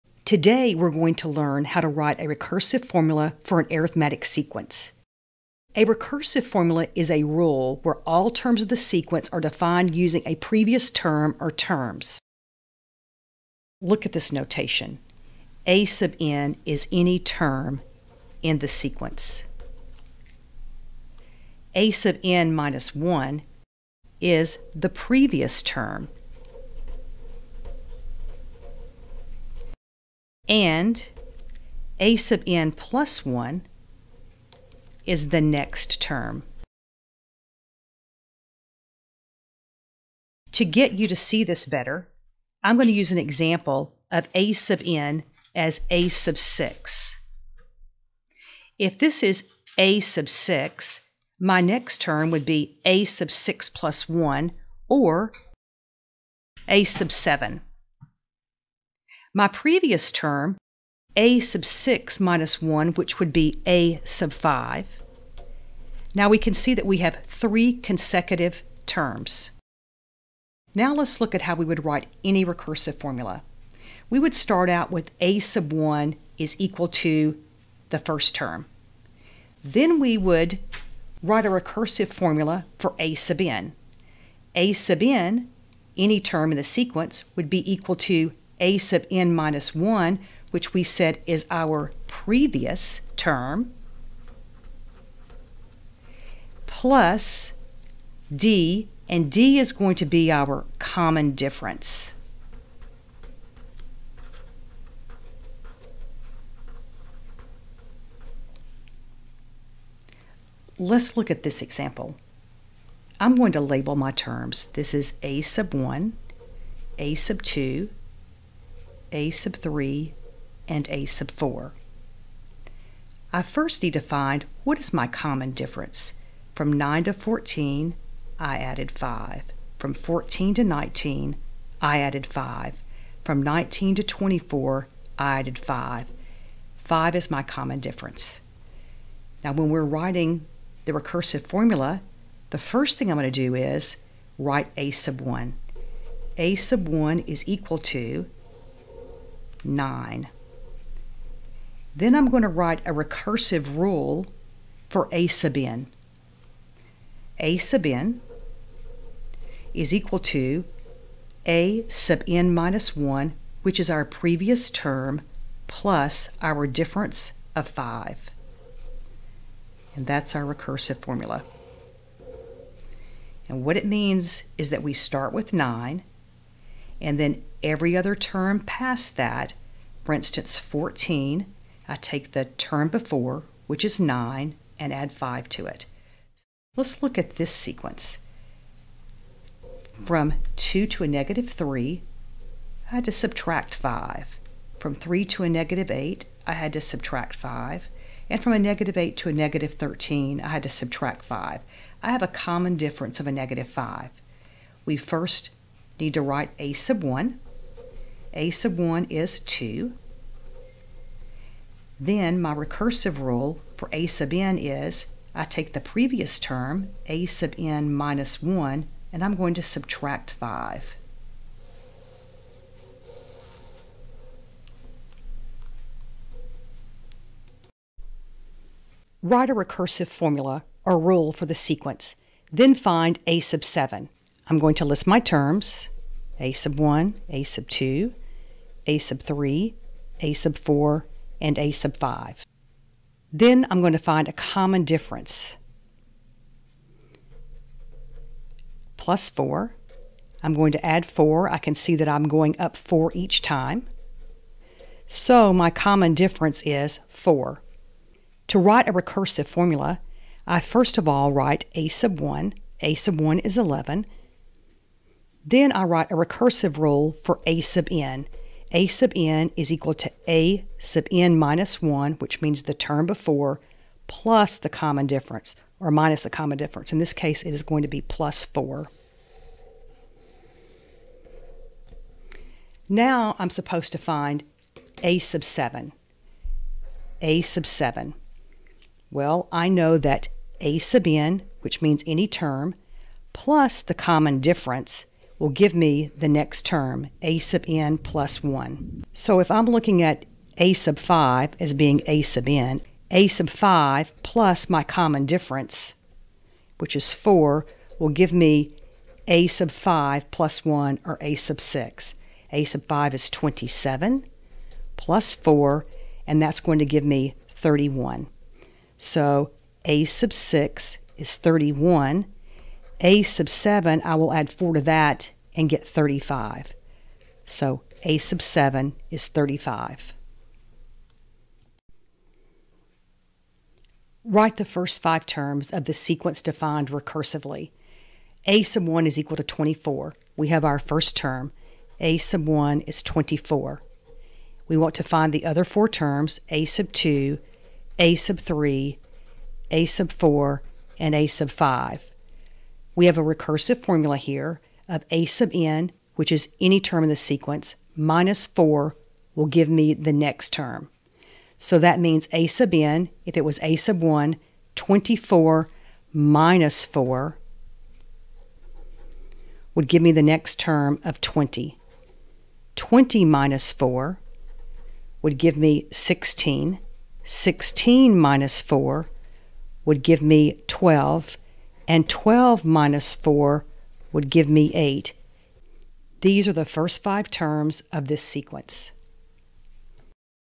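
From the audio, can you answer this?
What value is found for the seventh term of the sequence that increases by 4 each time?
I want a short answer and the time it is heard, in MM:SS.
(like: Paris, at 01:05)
35, at 05:28.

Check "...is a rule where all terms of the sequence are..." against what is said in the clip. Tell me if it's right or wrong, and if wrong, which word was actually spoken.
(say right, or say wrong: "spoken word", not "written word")
right.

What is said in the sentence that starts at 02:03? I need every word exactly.
I first need to find what is my common difference.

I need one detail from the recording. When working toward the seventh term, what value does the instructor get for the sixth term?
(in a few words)
31.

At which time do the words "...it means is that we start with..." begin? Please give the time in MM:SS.
02:53.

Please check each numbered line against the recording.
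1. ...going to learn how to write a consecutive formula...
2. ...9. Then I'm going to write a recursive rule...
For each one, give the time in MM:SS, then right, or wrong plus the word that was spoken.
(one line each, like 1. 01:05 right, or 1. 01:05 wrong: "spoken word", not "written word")
1. 00:00 wrong: "recursive", not "consecutive"
2. 02:29 right.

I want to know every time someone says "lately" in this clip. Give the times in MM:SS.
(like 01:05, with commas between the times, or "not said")
not said.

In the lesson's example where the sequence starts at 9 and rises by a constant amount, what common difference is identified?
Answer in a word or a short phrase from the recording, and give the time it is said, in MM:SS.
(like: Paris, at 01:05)
5, at 02:16.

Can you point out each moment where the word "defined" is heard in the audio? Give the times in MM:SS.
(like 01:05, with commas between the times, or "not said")
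00:09, 05:36.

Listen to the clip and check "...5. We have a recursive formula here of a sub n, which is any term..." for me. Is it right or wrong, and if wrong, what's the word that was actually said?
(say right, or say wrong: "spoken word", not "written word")
right.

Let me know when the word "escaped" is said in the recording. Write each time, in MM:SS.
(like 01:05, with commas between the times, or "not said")
not said.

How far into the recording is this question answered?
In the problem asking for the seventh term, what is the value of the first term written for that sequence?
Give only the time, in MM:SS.
04:22.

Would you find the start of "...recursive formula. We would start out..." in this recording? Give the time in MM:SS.
01:12.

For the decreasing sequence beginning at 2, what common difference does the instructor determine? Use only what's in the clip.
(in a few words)
-5.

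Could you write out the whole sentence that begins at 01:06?
Now we can see that we have three consecutive terms.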